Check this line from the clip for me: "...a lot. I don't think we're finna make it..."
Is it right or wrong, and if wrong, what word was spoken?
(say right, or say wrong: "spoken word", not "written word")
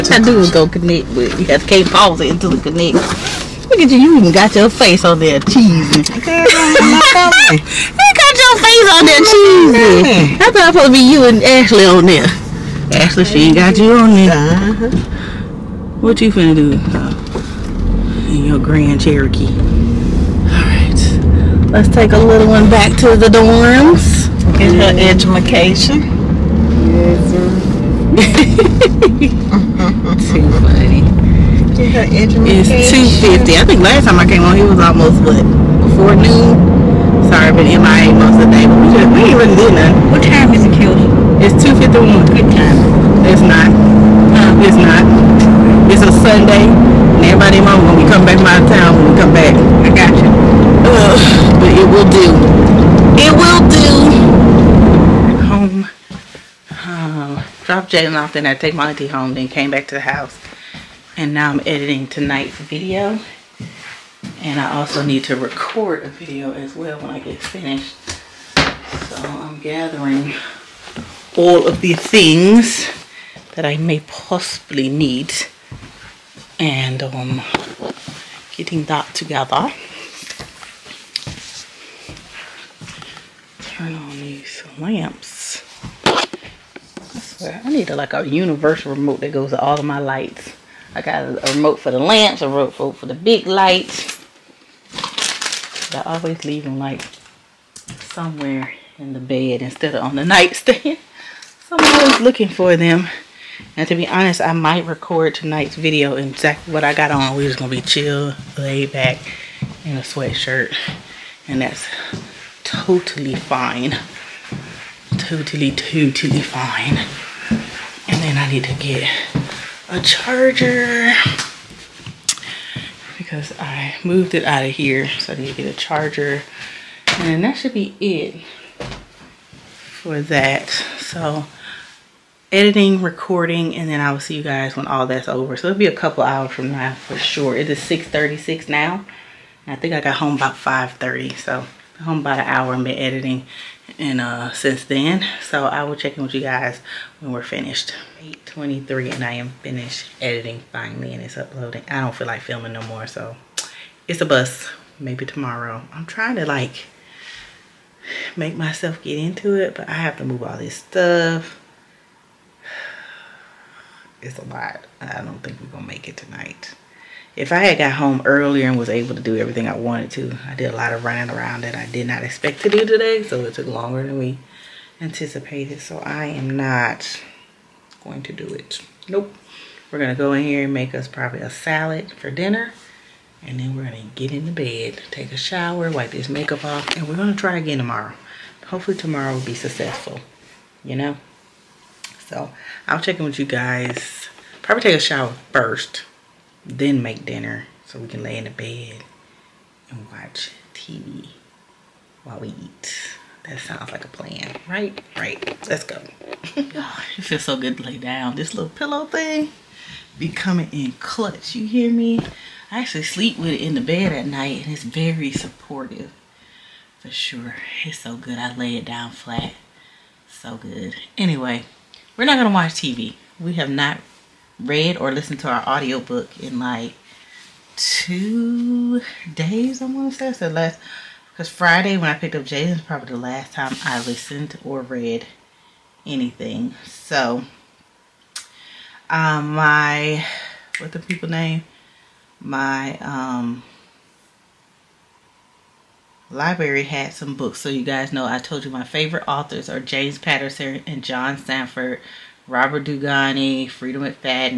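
wrong: "gonna", not "finna".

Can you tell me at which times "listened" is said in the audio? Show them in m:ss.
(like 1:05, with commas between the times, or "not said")
3:45, 3:54.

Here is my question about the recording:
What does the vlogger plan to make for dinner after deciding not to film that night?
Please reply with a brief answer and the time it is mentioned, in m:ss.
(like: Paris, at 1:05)
a salad, at 3:01.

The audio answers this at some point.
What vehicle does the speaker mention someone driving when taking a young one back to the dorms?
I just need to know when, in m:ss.
0:18.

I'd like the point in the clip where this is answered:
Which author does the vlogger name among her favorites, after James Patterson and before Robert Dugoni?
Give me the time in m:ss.
4:11.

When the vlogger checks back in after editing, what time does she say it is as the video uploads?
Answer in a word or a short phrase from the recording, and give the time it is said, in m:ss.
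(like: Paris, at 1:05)
8:23, at 2:28.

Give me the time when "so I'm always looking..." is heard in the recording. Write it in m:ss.
1:41.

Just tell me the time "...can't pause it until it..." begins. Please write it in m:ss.
0:01.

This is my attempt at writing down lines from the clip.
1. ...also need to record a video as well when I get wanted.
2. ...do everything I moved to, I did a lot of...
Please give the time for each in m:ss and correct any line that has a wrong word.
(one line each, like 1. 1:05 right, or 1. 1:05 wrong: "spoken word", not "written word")
1. 1:04 wrong: "finished", not "wanted"
2. 2:49 wrong: "wanted", not "moved".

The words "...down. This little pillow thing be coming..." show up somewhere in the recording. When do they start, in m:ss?
3:27.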